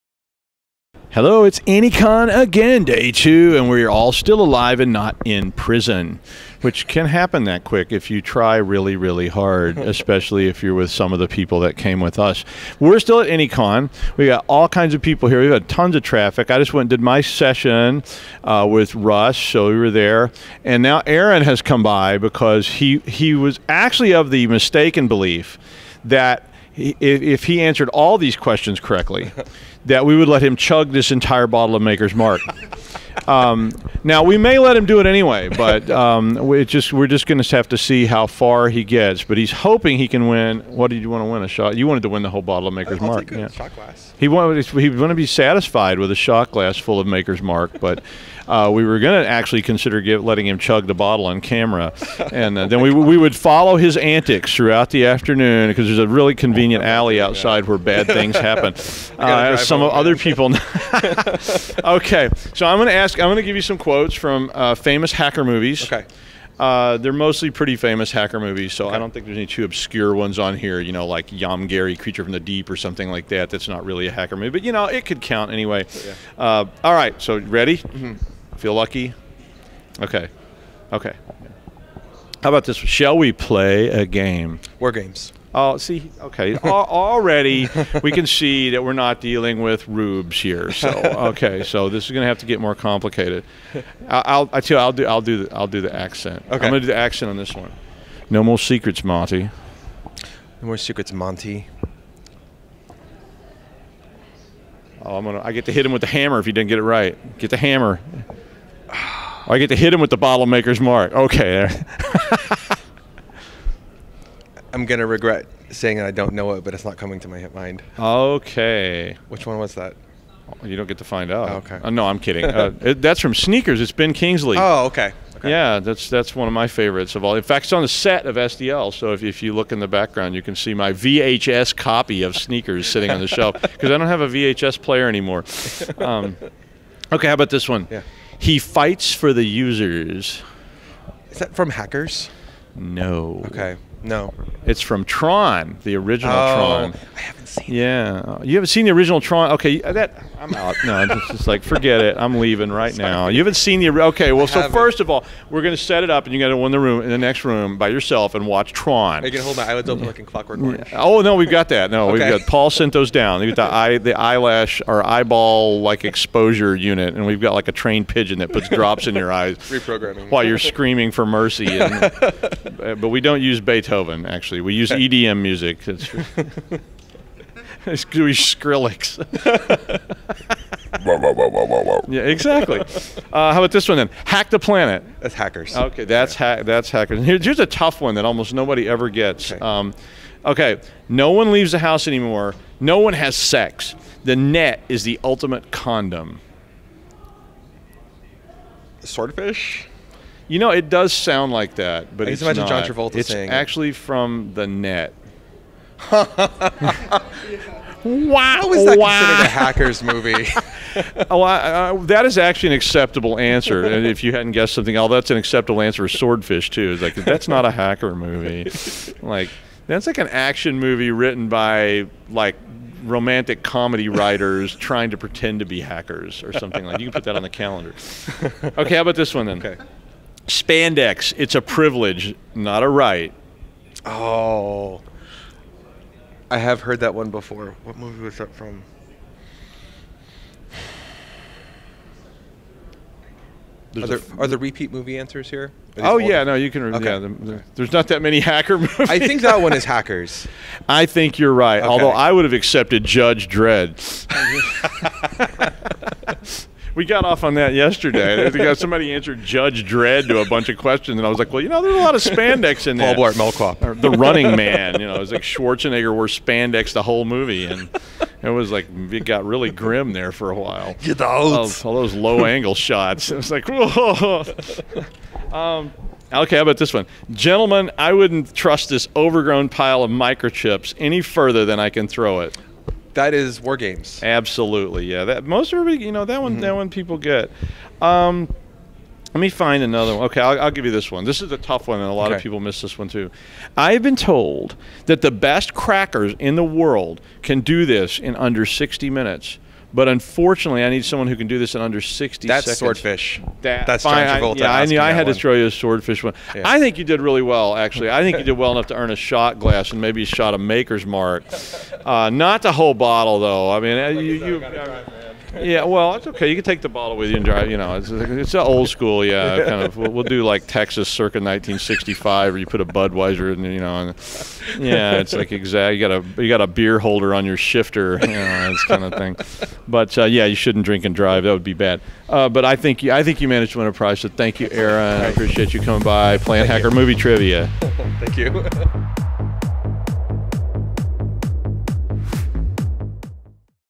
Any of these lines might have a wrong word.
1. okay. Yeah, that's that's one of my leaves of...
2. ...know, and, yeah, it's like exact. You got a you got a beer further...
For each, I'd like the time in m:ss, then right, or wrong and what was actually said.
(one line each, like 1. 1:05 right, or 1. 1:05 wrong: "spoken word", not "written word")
1. 2:05 wrong: "favorites", not "leaves"
2. 5:23 wrong: "holder", not "further".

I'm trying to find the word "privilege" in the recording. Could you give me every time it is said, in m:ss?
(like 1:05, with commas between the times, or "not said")
3:51.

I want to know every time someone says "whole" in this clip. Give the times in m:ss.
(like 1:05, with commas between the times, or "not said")
0:42, 4:27, 5:12.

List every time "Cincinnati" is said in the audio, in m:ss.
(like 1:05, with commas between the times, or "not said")
not said.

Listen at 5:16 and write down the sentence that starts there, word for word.
You can take the bottle with you and drive.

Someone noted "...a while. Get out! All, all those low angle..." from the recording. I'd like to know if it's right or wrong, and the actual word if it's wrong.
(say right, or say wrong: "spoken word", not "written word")
right.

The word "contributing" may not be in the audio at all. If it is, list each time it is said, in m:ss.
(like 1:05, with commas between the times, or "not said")
not said.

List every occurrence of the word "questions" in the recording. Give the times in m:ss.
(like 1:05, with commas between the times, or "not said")
0:28, 1:03, 4:20.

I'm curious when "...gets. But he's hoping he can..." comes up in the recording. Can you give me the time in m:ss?
0:38.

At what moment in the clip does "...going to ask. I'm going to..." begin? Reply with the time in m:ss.
1:02.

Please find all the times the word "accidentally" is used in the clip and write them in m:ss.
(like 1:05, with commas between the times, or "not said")
not said.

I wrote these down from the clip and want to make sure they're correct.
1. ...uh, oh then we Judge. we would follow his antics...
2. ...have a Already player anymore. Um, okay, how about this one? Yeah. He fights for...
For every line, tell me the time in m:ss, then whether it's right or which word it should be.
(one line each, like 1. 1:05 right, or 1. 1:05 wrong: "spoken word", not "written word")
1. 0:52 wrong: "God", not "Judge"
2. 2:14 wrong: "VHS", not "Already".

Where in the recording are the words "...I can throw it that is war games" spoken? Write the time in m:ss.
4:41.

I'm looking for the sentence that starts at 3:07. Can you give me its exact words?
here, here's a tough one that almost nobody ever gets.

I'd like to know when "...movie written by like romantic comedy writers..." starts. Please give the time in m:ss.
3:40.